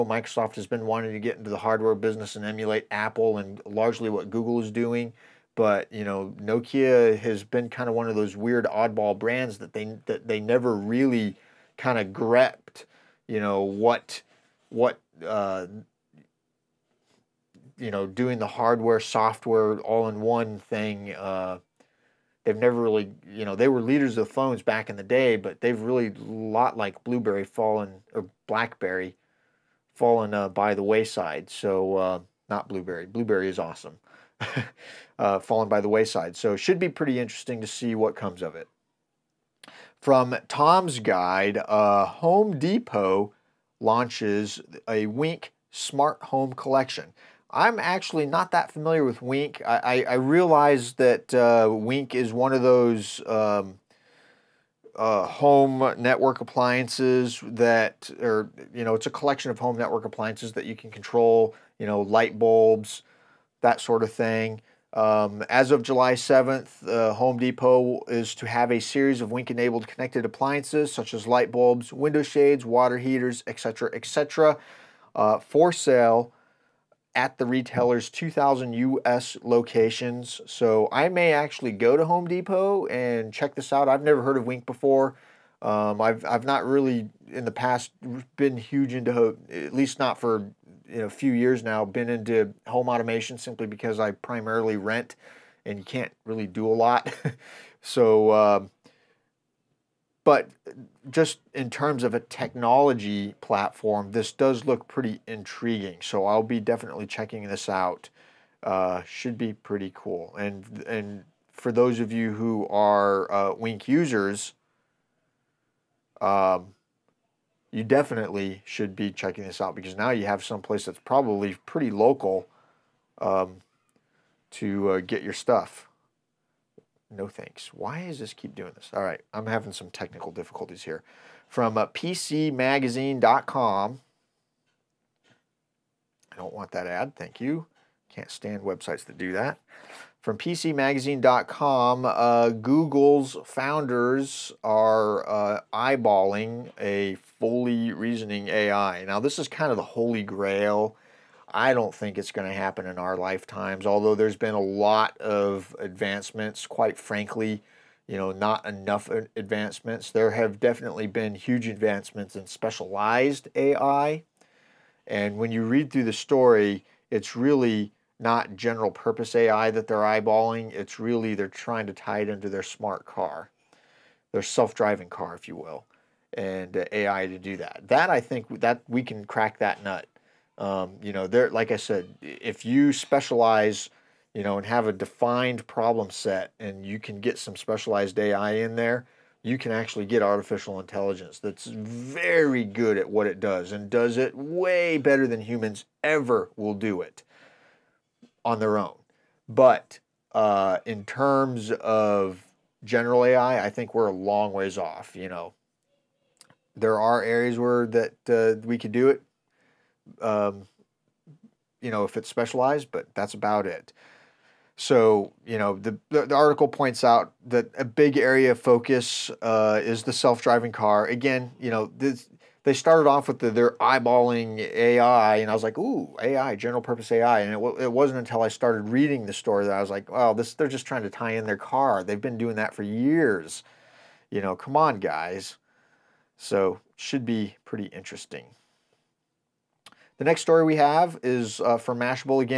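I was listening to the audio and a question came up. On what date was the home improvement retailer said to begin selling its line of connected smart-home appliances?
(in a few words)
July 7th.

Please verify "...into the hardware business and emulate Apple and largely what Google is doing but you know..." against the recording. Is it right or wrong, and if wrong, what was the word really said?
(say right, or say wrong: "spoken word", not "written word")
right.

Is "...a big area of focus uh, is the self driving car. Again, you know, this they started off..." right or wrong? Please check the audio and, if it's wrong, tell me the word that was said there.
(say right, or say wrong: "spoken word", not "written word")
right.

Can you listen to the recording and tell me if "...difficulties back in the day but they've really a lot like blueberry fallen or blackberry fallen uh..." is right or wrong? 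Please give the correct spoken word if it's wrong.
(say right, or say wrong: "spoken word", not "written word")
wrong: "phones", not "difficulties".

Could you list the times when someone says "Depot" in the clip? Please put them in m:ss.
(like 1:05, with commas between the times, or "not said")
0:42, 1:07, 1:22.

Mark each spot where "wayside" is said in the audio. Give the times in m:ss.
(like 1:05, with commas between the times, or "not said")
0:30, 0:35.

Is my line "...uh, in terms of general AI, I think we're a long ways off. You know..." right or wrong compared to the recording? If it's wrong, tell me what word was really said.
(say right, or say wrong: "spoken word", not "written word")
right.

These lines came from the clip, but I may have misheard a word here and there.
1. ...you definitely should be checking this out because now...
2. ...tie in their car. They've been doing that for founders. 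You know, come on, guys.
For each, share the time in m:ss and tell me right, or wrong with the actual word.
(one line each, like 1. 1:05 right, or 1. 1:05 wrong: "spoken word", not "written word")
1. 1:57 right
2. 3:51 wrong: "years", not "founders".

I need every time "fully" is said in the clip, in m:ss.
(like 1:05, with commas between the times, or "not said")
2:27.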